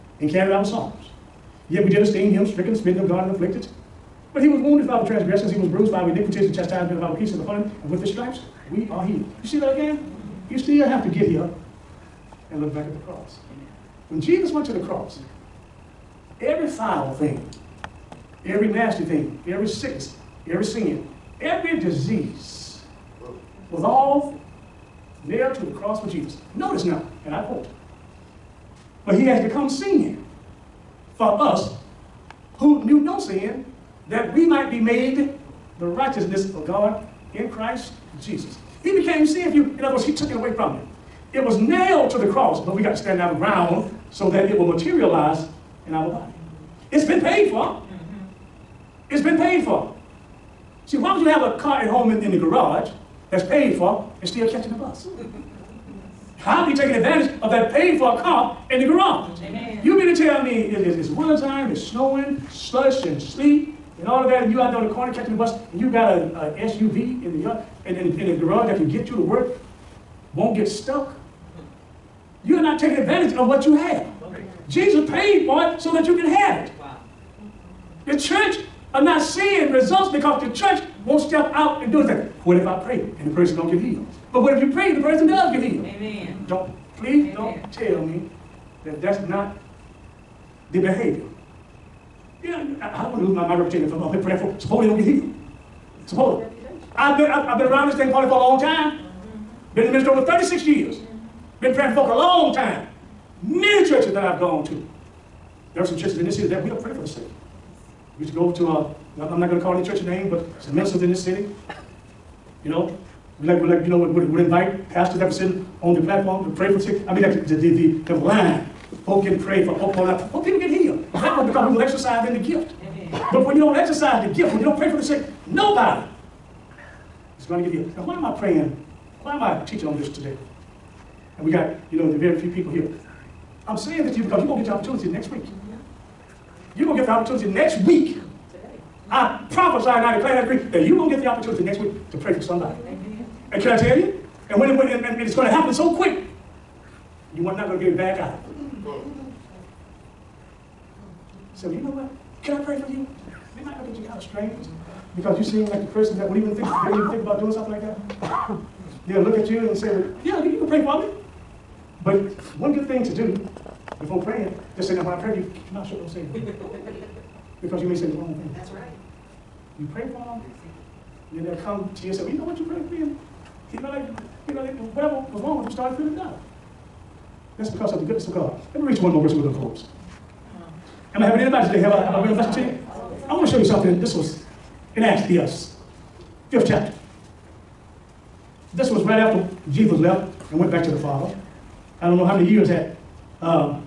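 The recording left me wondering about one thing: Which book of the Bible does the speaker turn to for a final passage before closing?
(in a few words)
Acts.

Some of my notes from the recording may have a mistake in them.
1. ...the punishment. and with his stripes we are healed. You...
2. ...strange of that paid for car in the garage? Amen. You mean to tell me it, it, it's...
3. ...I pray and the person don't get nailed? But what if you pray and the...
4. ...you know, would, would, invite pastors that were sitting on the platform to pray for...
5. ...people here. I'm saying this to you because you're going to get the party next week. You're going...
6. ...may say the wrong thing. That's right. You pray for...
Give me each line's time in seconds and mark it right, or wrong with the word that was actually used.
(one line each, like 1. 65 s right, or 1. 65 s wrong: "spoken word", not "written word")
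1. 7 s right
2. 56 s wrong: "advantage", not "strange"
3. 82 s wrong: "healed", not "nailed"
4. 113 s right
5. 132 s wrong: "opportunity", not "party"
6. 167 s right.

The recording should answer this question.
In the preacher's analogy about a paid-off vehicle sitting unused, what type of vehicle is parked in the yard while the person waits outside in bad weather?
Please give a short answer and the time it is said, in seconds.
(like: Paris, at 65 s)
SUV, at 66 s.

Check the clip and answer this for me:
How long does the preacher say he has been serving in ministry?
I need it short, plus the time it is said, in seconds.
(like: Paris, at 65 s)
over 36 years, at 100 s.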